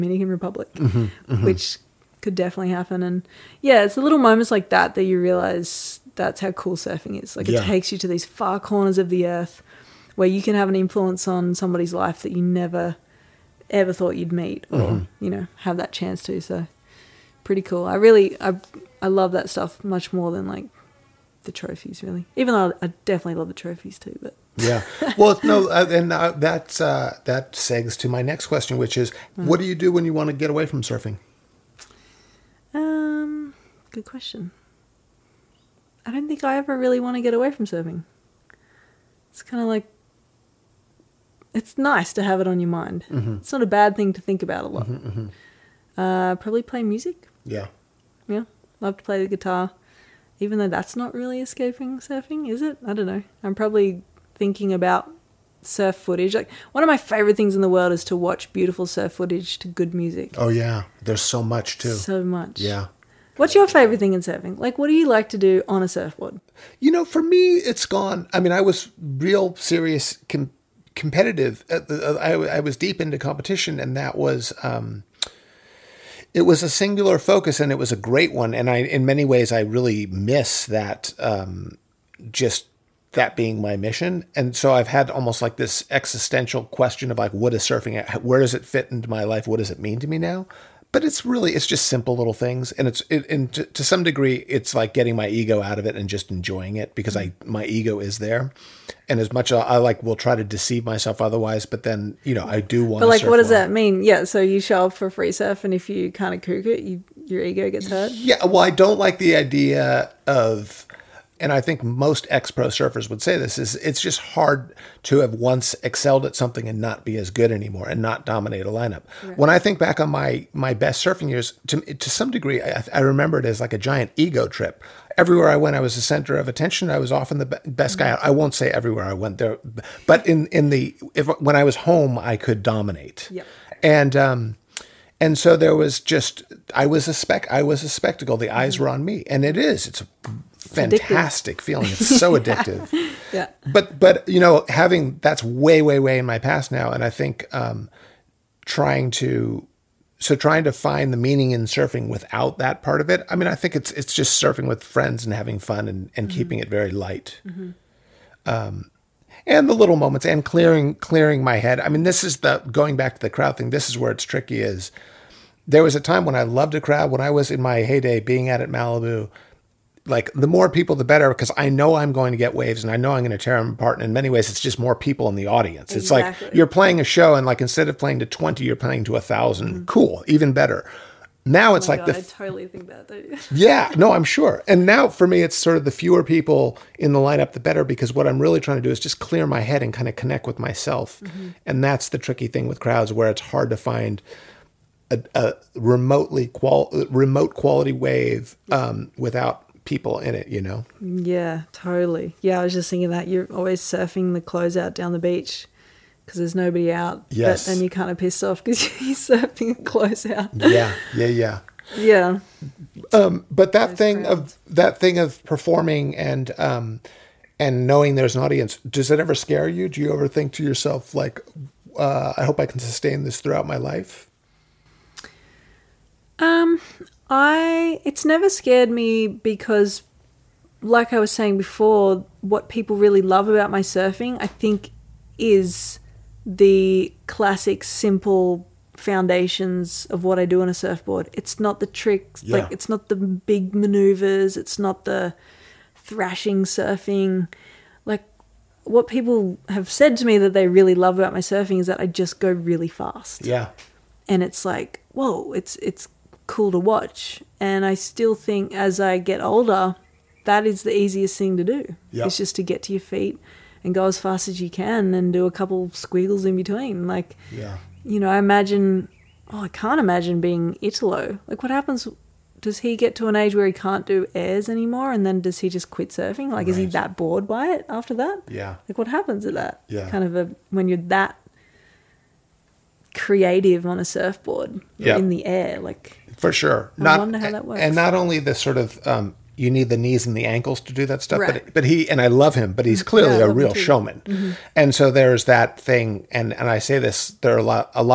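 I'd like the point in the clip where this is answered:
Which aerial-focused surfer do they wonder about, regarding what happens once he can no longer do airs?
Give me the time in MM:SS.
04:30.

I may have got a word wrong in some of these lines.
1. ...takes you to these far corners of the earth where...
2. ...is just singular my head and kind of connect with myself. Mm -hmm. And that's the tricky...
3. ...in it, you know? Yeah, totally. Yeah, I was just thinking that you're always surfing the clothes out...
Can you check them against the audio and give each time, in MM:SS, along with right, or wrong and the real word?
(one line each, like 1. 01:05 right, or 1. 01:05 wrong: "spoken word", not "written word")
1. 00:07 right
2. 03:08 wrong: "clear", not "singular"
3. 03:20 right.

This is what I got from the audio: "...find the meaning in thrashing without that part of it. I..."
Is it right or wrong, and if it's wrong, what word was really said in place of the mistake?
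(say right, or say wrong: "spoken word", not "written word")
wrong: "surfing", not "thrashing".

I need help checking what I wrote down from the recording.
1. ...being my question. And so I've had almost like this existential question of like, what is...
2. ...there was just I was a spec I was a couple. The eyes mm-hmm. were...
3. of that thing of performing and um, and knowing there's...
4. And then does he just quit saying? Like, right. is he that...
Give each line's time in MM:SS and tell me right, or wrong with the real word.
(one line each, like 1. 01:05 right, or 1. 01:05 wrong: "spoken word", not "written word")
1. 01:23 wrong: "mission", not "question"
2. 02:15 wrong: "spectacle", not "couple"
3. 03:34 right
4. 04:35 wrong: "surfing", not "saying".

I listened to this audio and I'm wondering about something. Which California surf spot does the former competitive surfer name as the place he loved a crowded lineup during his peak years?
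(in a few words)
Malibu.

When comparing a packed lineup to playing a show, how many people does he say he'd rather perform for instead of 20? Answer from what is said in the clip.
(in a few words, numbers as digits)
1000.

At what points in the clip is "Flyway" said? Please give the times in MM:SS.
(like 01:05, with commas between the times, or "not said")
not said.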